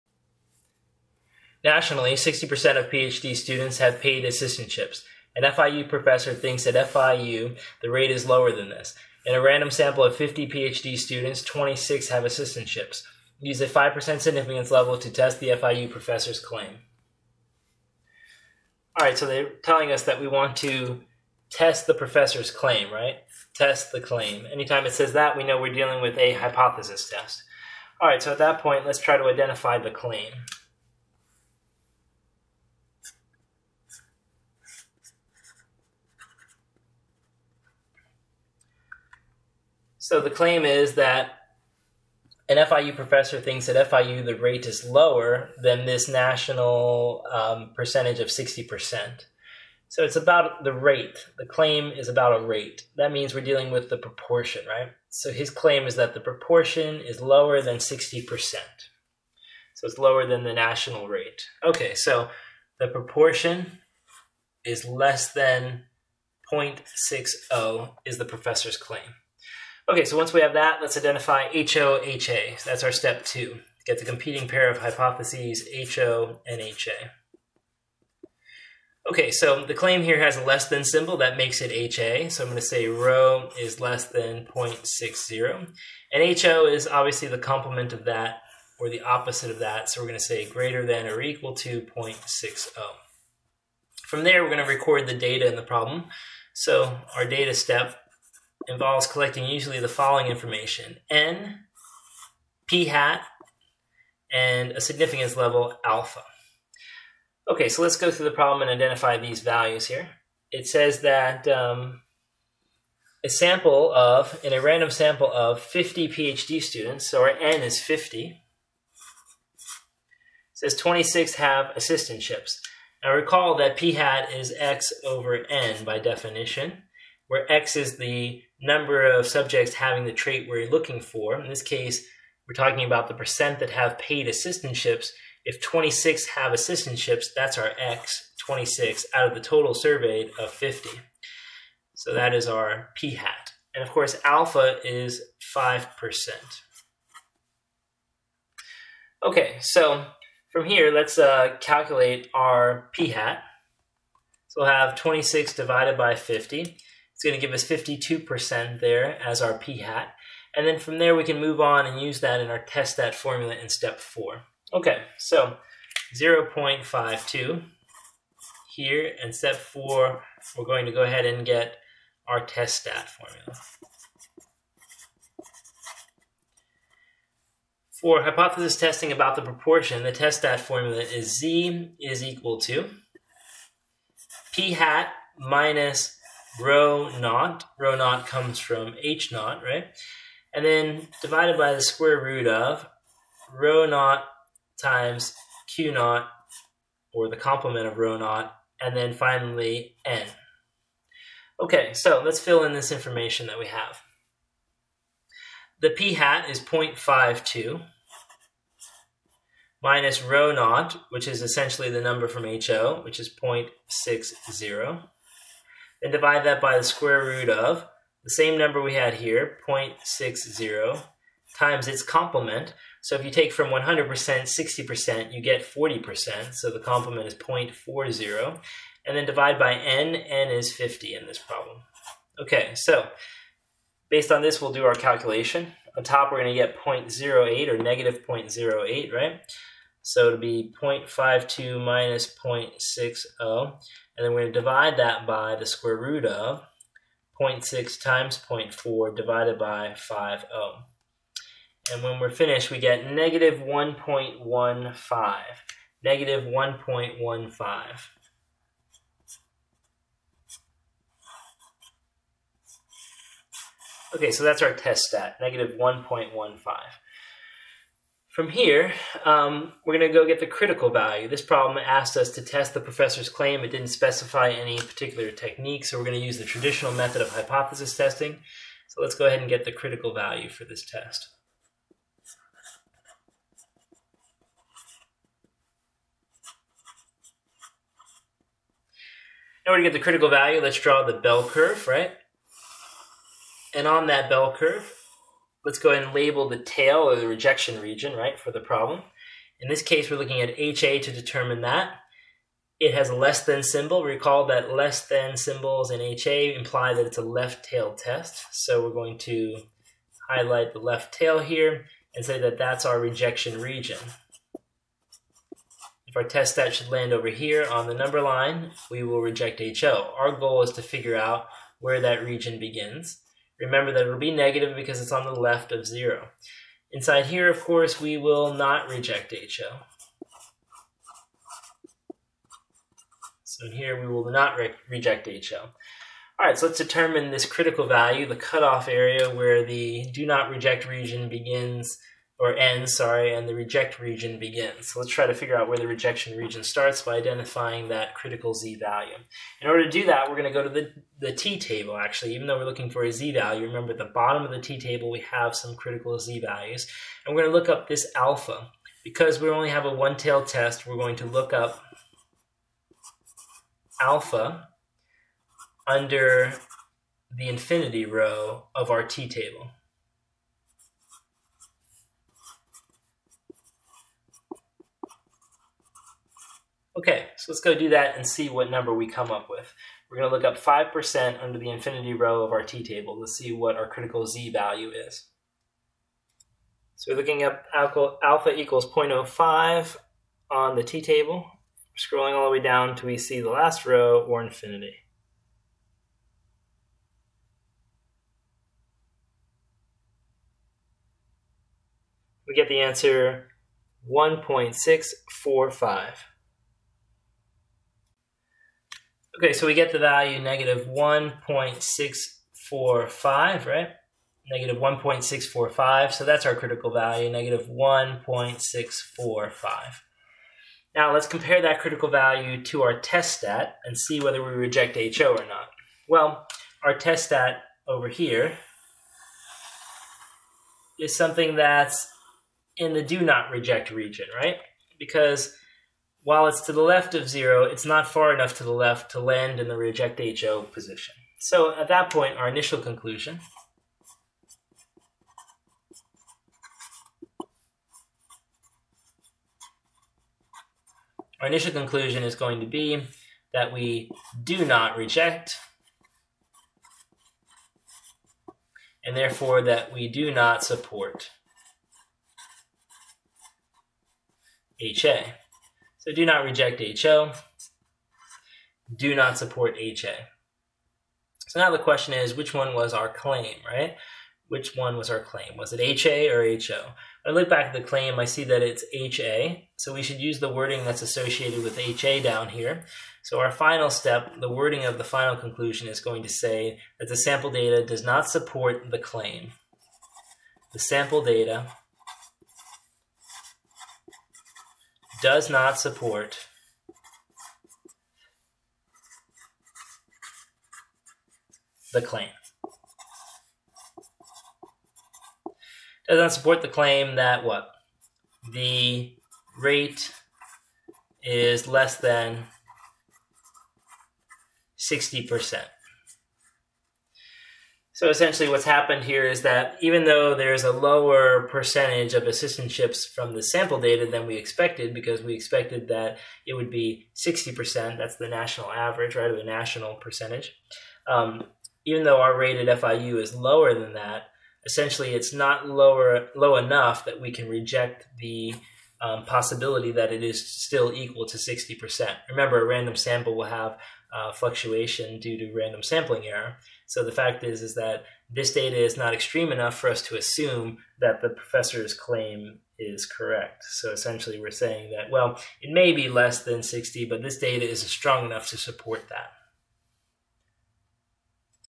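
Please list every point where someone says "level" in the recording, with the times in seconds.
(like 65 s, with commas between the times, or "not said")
14 s, 105 s.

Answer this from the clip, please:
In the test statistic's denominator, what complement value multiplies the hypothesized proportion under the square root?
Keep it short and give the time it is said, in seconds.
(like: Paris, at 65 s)
0.40, at 227 s.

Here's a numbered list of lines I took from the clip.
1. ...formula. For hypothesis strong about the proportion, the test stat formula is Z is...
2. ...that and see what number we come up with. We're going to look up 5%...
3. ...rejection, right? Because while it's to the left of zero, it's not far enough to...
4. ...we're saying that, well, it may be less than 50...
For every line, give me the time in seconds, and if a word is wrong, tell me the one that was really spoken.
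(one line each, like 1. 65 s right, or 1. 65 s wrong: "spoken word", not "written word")
1. 173 s wrong: "testing", not "strong"
2. 377 s right
3. 433 s wrong: "region", not "rejection"
4. 554 s wrong: "60", not "50".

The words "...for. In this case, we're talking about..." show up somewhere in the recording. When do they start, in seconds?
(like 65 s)
130 s.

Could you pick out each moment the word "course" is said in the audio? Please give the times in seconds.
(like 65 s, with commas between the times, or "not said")
143 s, 327 s.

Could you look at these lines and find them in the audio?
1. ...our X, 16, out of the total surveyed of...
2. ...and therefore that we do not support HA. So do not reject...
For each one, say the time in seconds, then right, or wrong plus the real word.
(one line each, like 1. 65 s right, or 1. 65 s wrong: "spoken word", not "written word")
1. 137 s wrong: "26", not "16"
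2. 459 s right.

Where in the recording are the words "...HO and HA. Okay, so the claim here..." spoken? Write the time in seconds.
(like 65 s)
75 s.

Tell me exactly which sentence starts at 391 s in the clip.
Scrolling all the way down till we see the last row or infinity.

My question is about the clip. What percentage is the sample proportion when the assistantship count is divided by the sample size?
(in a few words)
52%.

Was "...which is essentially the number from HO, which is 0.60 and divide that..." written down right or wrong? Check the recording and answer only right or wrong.
right.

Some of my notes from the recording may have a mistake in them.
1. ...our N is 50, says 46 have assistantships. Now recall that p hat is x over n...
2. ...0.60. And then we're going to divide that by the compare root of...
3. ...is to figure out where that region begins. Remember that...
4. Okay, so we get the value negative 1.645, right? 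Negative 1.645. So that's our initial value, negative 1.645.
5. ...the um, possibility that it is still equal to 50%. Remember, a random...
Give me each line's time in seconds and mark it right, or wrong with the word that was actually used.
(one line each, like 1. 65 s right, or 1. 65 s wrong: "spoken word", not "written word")
1. 117 s wrong: "26", not "46"
2. 242 s wrong: "square", not "compare"
3. 320 s right
4. 409 s wrong: "critical", not "initial"
5. 538 s wrong: "60", not "50".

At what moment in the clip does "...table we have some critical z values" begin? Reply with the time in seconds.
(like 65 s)
354 s.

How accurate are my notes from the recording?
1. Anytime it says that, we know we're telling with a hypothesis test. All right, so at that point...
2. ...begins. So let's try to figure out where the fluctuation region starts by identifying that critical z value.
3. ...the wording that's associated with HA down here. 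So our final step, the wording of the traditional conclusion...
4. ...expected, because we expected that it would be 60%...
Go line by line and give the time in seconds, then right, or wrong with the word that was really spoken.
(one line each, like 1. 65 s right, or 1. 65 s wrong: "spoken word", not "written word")
1. 24 s wrong: "dealing", not "telling"
2. 344 s wrong: "rejection", not "fluctuation"
3. 480 s wrong: "final", not "traditional"
4. 524 s right.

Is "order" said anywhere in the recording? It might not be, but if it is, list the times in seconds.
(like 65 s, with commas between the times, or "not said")
289 s, 349 s.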